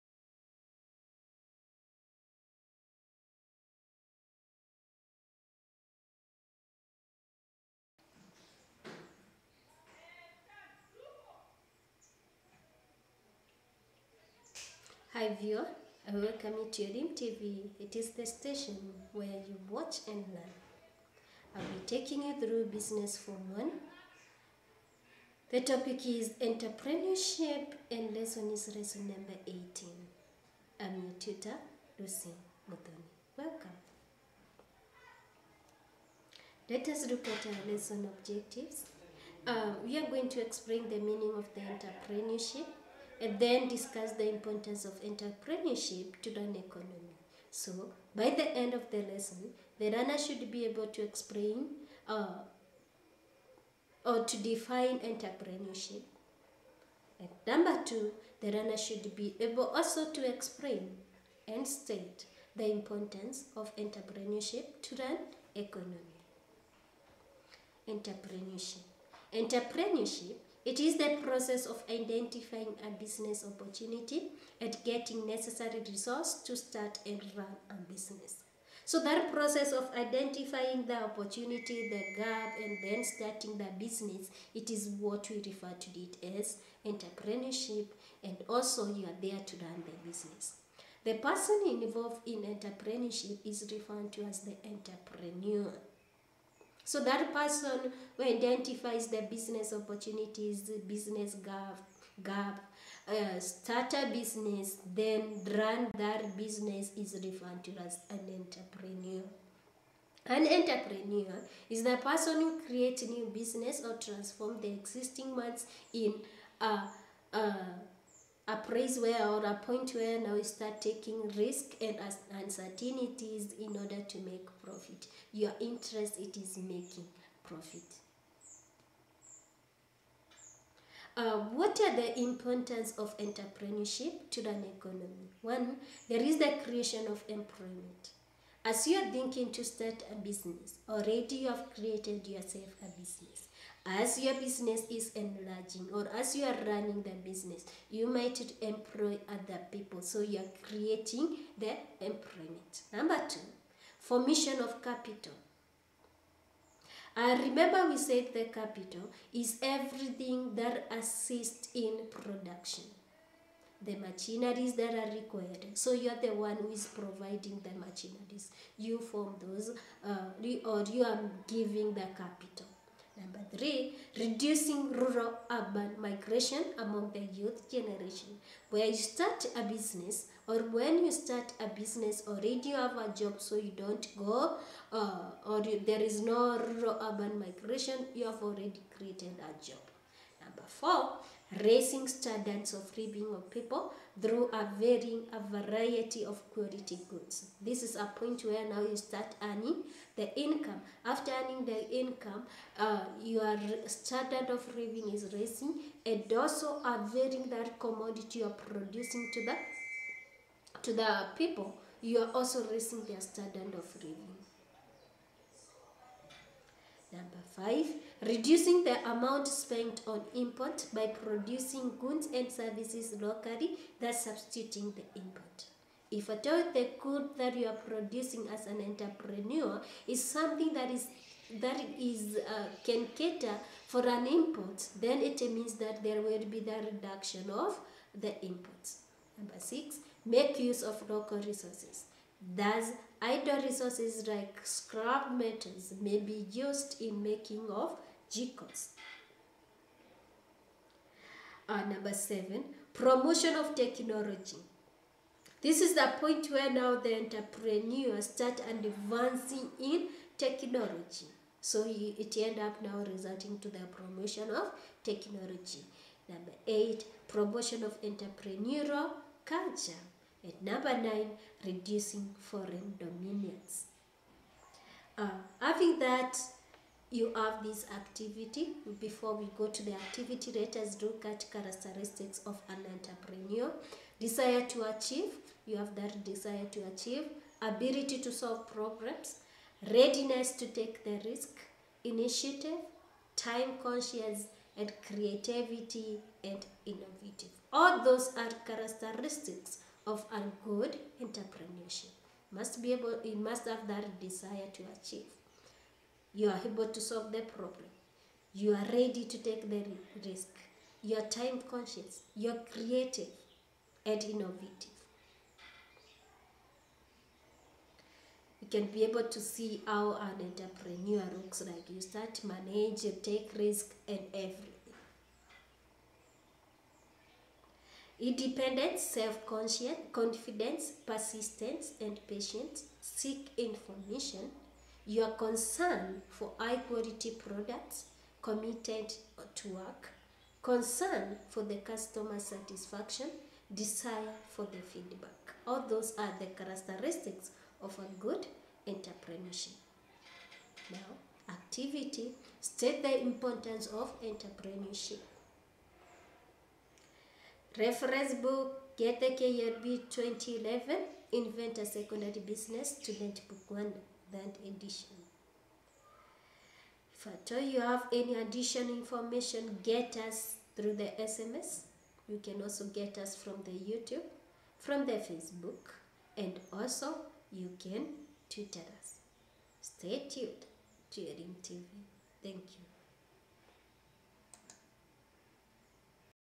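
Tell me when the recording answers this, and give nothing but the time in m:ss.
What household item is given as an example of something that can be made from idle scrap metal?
4:08.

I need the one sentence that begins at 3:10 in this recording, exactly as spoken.
Number four, raising standards of living of people through a, varying, a variety of quality goods.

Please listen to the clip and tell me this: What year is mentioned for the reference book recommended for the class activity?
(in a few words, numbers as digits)
2011.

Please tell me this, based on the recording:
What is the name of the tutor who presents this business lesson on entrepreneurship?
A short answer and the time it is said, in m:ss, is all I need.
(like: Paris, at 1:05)
Lucy Mudoni, at 0:31.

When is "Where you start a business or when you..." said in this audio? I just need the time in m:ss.
2:58.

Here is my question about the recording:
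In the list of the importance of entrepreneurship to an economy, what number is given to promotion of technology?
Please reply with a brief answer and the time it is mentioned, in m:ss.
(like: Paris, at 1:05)
7, at 4:11.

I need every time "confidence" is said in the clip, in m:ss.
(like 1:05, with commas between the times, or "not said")
5:30.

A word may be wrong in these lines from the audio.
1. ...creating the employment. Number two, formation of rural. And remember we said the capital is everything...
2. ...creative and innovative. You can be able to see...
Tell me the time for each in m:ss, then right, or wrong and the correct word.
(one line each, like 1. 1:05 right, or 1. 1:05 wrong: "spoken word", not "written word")
1. 2:30 wrong: "capital", not "rural"
2. 5:12 right.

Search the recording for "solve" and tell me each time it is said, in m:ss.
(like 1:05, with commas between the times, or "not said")
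4:48, 5:07.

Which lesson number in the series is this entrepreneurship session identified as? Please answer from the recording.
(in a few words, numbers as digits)
18.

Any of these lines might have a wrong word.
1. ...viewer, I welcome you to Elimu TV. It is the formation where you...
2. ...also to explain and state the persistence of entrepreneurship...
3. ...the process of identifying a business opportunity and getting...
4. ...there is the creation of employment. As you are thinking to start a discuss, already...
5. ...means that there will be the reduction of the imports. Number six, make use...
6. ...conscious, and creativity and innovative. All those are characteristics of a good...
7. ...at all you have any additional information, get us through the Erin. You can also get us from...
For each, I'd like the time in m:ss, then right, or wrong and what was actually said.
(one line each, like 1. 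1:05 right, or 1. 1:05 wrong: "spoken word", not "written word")
1. 0:15 wrong: "station", not "formation"
2. 0:59 wrong: "importance", not "persistence"
3. 1:10 right
4. 2:16 wrong: "business", not "discuss"
5. 3:55 right
6. 4:53 right
7. 6:07 wrong: "SMS", not "Erin".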